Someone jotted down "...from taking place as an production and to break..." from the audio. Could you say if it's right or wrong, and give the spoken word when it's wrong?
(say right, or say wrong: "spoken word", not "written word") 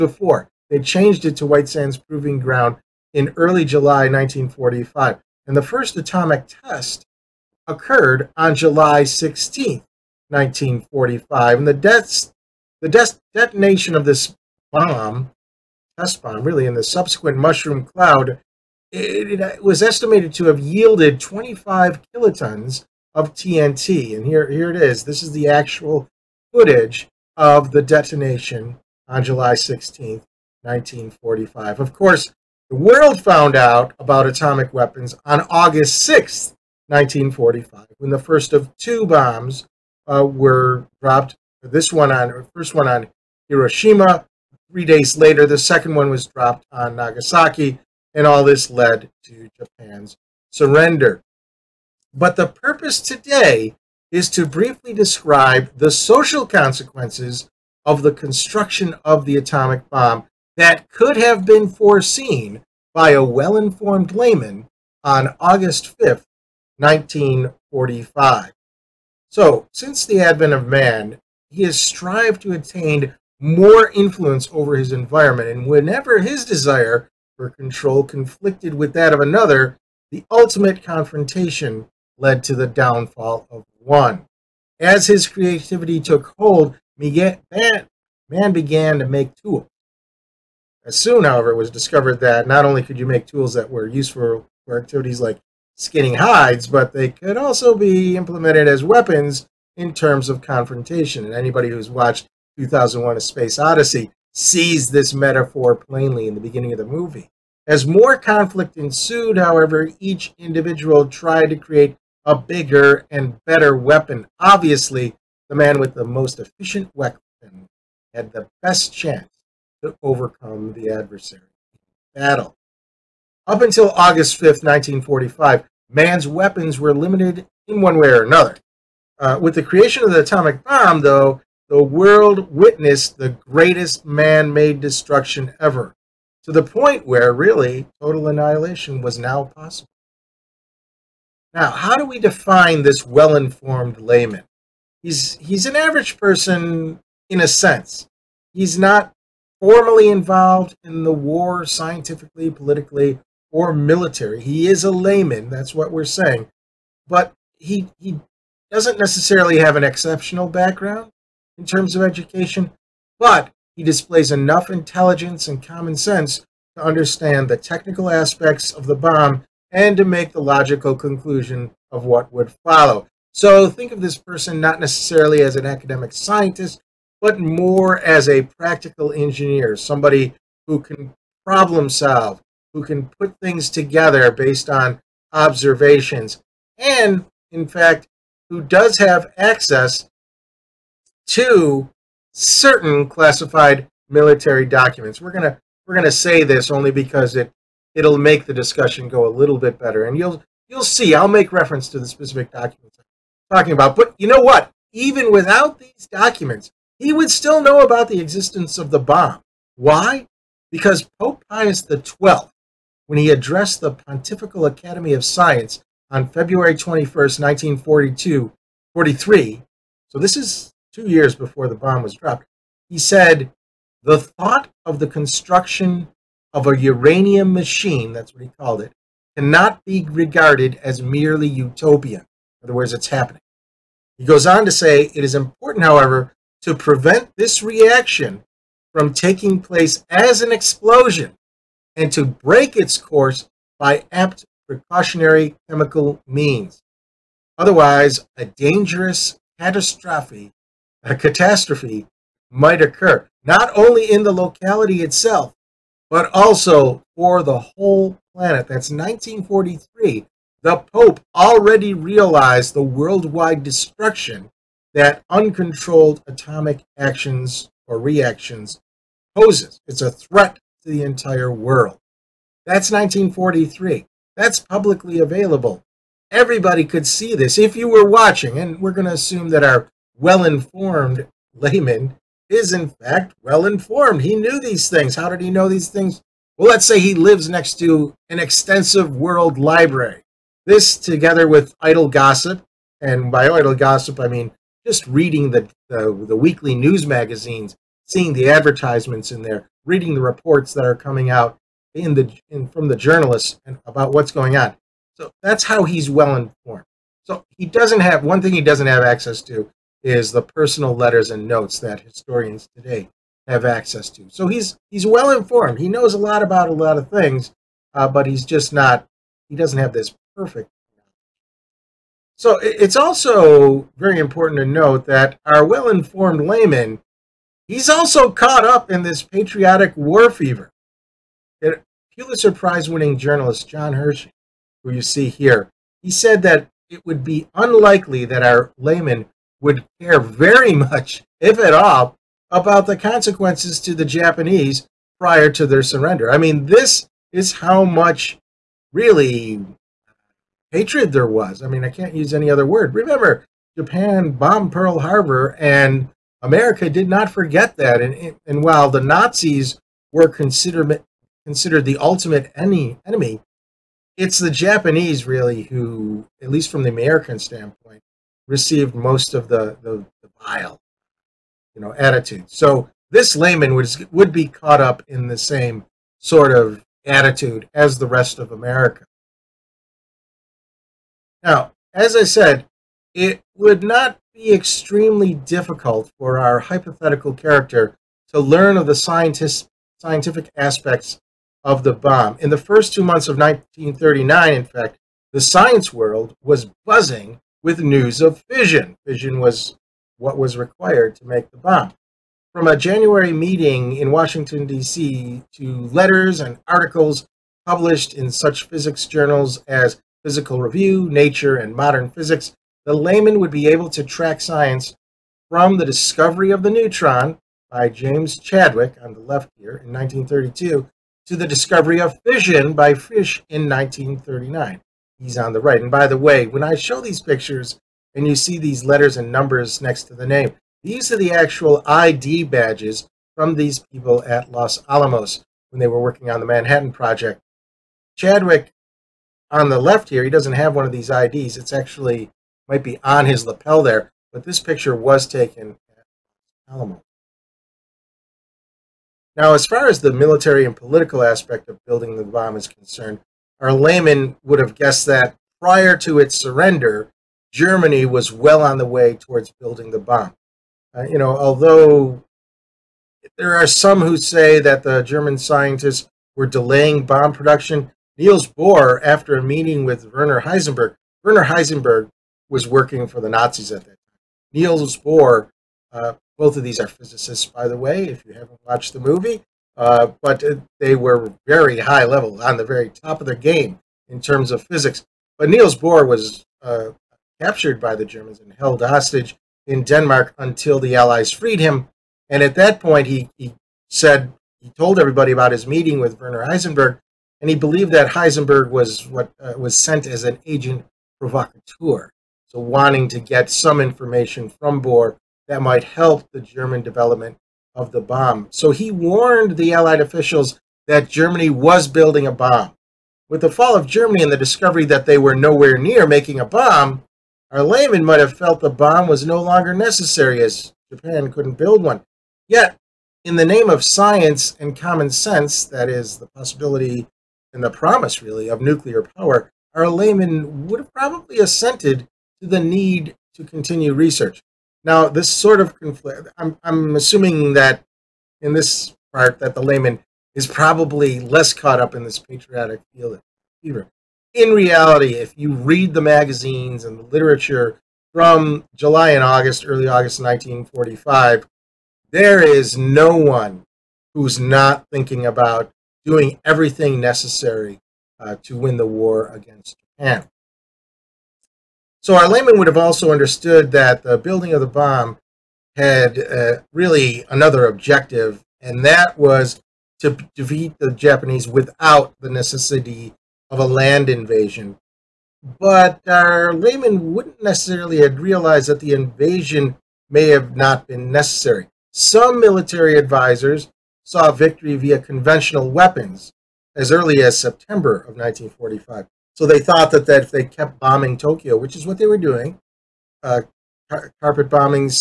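wrong: "explosion", not "production".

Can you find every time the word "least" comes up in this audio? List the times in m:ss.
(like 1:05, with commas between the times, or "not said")
6:06.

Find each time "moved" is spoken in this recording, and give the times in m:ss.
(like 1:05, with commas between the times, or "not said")
not said.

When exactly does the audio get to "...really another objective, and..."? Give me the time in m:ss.
9:26.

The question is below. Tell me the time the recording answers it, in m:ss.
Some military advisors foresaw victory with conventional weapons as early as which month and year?
9:47.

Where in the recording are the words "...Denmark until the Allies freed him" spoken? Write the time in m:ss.
8:09.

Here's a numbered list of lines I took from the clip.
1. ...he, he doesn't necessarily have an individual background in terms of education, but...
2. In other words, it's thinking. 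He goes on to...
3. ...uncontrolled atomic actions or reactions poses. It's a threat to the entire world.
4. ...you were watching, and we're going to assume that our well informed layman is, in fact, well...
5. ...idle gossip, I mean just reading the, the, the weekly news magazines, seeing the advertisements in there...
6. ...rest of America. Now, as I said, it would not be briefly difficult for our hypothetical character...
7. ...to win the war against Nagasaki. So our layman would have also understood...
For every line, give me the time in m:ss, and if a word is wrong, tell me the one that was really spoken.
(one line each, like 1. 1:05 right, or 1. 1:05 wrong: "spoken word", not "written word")
1. 2:37 wrong: "exceptional", not "individual"
2. 3:52 wrong: "happening", not "thinking"
3. 4:25 right
4. 4:37 right
5. 4:53 right
6. 6:18 wrong: "extremely", not "briefly"
7. 9:18 wrong: "Japan", not "Nagasaki".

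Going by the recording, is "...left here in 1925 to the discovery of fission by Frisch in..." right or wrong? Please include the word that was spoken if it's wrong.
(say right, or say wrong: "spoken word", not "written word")
wrong: "1932", not "1925".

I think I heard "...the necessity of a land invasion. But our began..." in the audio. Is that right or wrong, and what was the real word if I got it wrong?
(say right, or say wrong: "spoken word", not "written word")
wrong: "layman", not "began".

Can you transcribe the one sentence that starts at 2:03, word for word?
Up until August 5th, 1945, man's weapons were limited in one way or another.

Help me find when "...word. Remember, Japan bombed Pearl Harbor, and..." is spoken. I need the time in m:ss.
5:52.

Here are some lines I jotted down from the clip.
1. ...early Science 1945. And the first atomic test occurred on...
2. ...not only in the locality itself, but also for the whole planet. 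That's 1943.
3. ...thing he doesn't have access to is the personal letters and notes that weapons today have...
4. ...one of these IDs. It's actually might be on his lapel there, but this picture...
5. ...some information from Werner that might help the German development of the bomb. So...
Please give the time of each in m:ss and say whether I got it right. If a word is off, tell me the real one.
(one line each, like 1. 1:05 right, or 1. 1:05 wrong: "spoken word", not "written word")
1. 0:03 wrong: "July", not "Science"
2. 4:13 right
3. 5:08 wrong: "historians", not "weapons"
4. 7:20 right
5. 8:23 wrong: "Bohr", not "Werner".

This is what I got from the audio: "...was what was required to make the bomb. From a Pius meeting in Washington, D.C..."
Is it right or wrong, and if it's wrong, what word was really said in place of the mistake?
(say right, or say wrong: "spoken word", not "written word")
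wrong: "January", not "Pius".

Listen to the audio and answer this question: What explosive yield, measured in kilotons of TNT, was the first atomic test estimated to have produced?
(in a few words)
25 kilotons.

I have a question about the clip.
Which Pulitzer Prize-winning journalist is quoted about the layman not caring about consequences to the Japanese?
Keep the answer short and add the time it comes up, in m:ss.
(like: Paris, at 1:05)
John Hersey, at 5:33.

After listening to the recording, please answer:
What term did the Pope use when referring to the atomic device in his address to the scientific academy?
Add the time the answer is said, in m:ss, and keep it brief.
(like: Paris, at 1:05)
uranium machine, at 3:46.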